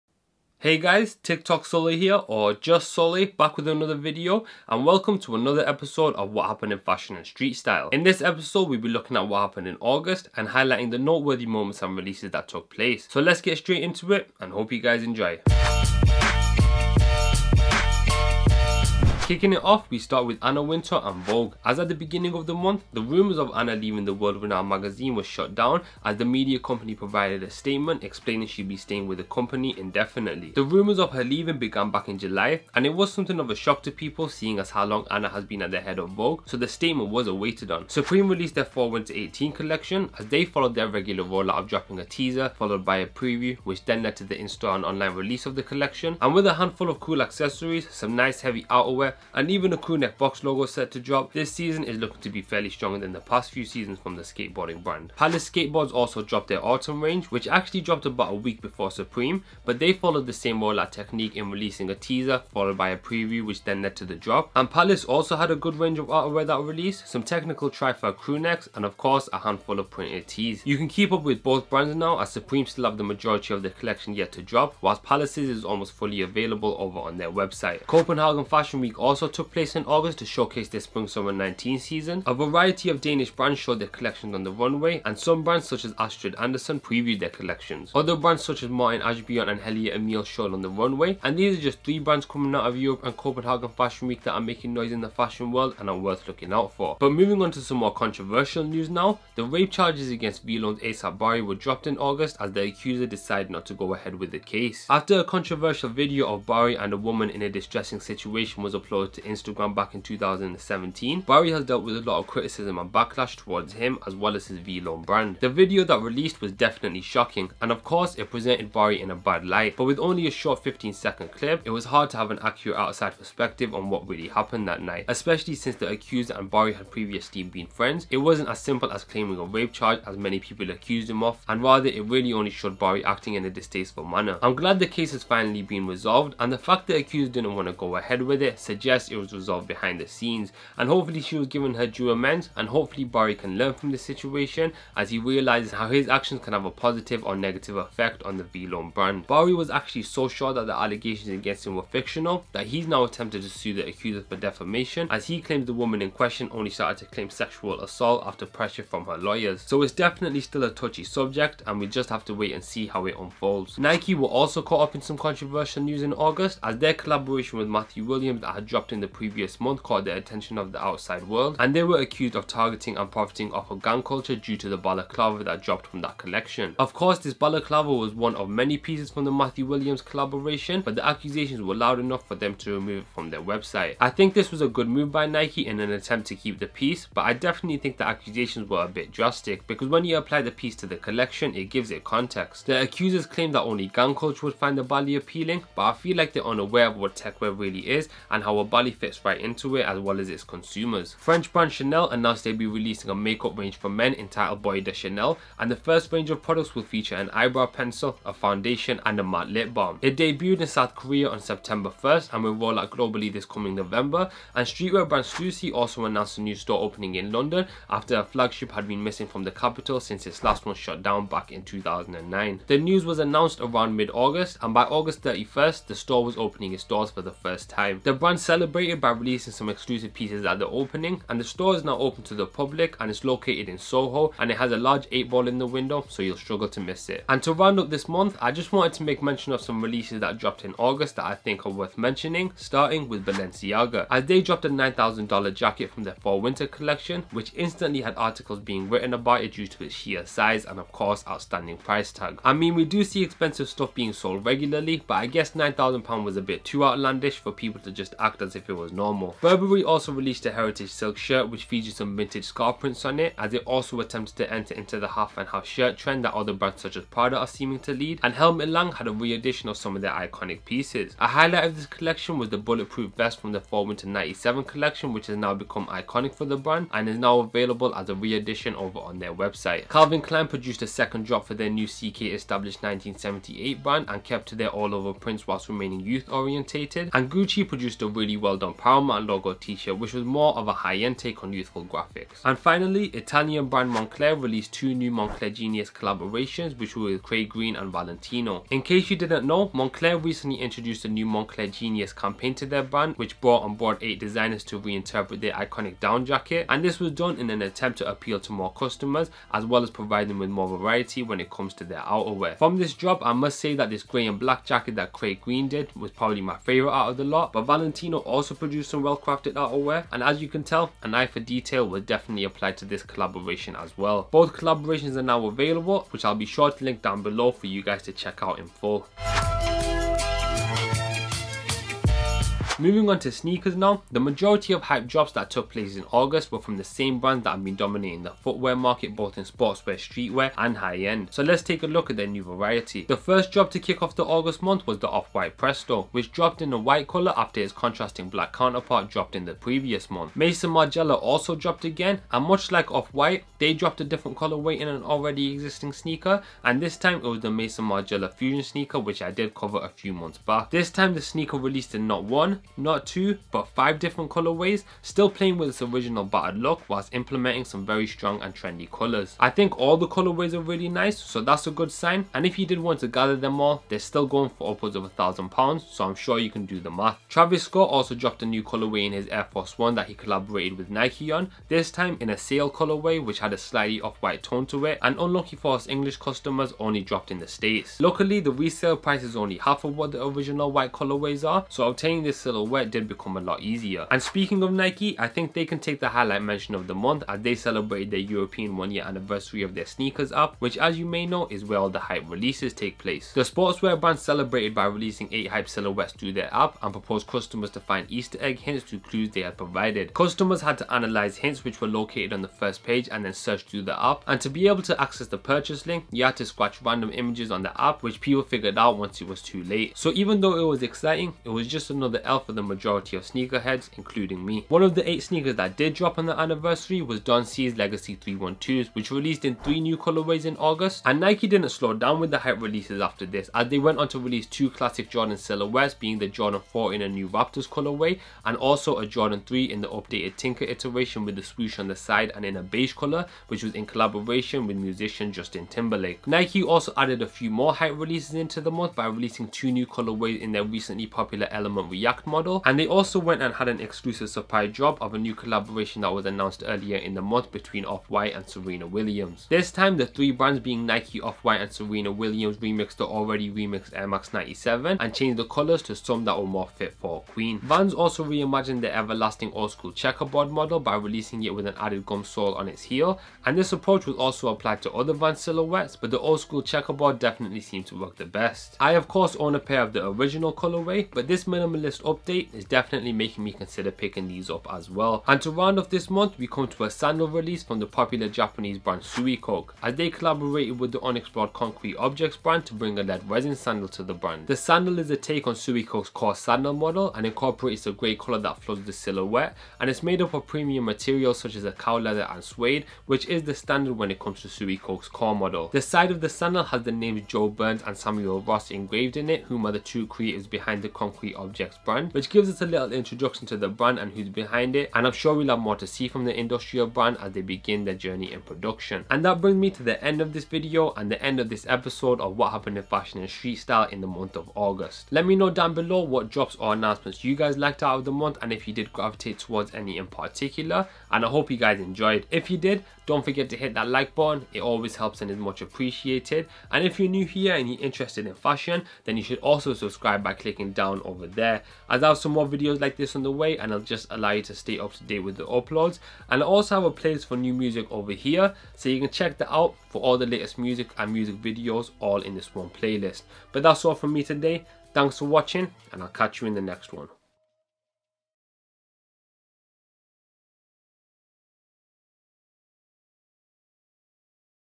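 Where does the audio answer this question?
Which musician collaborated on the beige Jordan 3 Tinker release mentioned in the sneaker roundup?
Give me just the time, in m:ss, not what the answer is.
7:25.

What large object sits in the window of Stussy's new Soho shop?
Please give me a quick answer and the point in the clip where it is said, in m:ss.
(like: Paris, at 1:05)
8 ball, at 3:55.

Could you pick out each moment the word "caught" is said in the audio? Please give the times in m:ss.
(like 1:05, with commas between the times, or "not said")
2:44, 2:49.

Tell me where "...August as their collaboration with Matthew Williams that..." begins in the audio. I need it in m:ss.
2:46.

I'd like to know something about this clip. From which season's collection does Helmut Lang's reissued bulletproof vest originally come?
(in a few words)
Fall Winter 97.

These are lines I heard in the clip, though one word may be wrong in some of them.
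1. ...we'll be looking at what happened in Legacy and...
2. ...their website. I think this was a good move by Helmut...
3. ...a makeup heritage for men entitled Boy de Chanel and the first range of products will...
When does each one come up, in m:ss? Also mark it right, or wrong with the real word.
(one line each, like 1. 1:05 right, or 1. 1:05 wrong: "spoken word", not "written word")
1. 0:08 wrong: "August", not "Legacy"
2. 3:03 wrong: "Nike", not "Helmut"
3. 3:23 wrong: "range", not "heritage".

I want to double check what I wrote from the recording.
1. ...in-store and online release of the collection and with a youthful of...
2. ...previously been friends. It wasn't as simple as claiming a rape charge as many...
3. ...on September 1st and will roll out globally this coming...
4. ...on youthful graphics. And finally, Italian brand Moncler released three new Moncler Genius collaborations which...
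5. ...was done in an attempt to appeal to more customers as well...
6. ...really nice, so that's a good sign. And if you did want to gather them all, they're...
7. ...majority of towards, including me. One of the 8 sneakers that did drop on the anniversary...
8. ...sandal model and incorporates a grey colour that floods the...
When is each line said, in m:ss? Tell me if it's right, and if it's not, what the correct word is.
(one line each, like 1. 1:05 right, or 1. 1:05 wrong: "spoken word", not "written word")
1. 0:44 wrong: "handful", not "youthful"
2. 2:06 right
3. 3:31 right
4. 4:51 wrong: "two", not "three"
5. 5:06 right
6. 6:10 right
7. 7:02 wrong: "sneakerheads", not "towards"
8. 8:16 right.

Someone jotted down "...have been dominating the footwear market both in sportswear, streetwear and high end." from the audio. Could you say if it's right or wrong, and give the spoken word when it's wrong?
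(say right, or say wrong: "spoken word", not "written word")
right.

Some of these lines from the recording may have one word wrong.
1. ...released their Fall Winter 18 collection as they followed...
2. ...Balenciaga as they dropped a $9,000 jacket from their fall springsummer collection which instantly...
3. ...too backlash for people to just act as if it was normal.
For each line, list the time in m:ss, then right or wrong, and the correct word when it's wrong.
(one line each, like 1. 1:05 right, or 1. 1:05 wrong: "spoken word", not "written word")
1. 0:38 right
2. 4:03 wrong: "winter", not "springsummer"
3. 4:16 wrong: "outlandish", not "backlash".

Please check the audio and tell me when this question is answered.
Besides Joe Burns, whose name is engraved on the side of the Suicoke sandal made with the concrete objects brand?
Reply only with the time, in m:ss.
8:27.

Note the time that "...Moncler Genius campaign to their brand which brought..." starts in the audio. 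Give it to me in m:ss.
5:01.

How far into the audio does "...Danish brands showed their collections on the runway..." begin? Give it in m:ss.
1:23.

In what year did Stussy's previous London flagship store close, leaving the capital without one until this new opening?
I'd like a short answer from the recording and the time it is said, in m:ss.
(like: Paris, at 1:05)
2009, at 3:41.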